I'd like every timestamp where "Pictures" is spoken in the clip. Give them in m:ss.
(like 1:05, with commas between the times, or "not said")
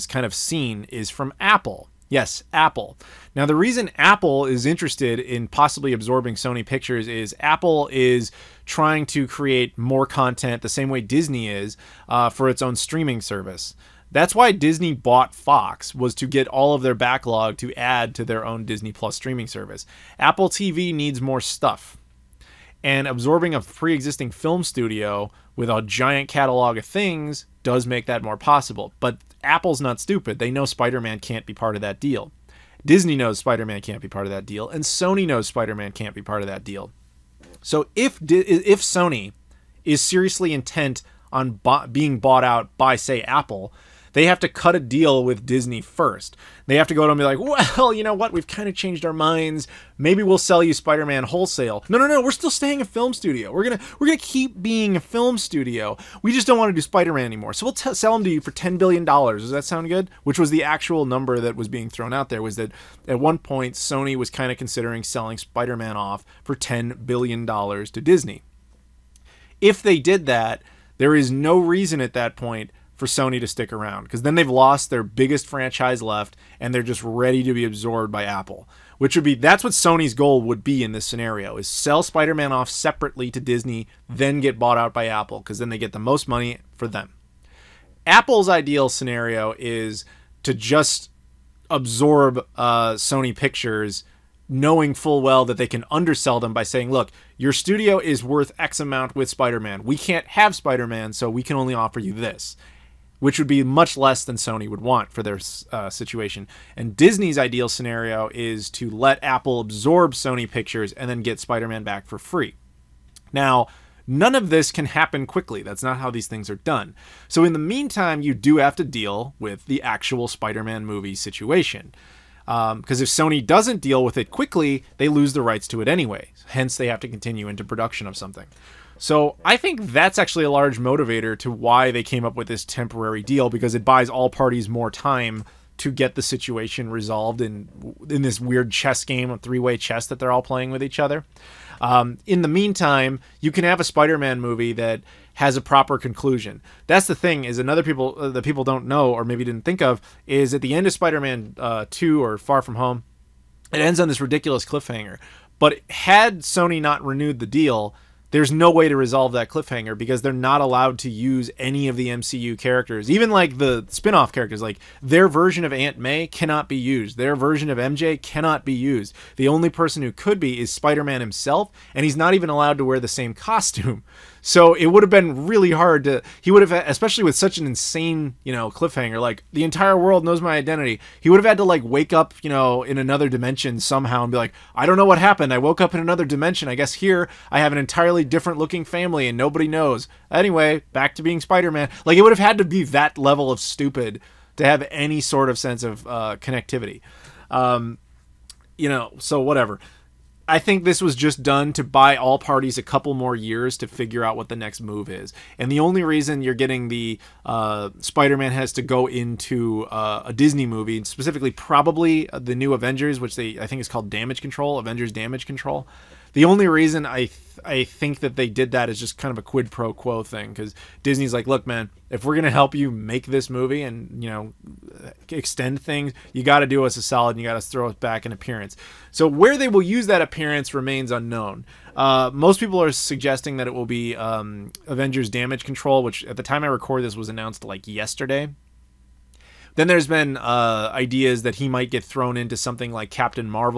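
0:06, 1:33, 1:50.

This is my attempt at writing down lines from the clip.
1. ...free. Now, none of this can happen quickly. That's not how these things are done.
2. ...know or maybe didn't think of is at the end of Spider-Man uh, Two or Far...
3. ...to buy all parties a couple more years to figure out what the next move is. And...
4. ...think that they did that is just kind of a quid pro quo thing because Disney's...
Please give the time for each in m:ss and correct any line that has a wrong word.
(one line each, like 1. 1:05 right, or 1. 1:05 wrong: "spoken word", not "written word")
1. 1:52 right
2. 2:28 right
3. 3:21 right
4. 3:37 right.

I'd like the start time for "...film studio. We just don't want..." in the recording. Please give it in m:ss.
0:55.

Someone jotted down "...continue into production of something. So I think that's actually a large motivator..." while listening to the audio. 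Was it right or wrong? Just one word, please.
right.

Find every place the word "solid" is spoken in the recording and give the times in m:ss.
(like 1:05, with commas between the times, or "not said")
3:47.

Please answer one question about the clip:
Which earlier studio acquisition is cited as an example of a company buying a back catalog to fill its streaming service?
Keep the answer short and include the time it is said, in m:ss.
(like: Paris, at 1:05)
Fox, at 0:15.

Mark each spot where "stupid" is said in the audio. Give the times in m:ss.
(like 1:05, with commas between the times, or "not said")
0:29, 3:13.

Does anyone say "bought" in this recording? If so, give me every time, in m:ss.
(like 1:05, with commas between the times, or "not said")
0:14, 0:42, 1:24.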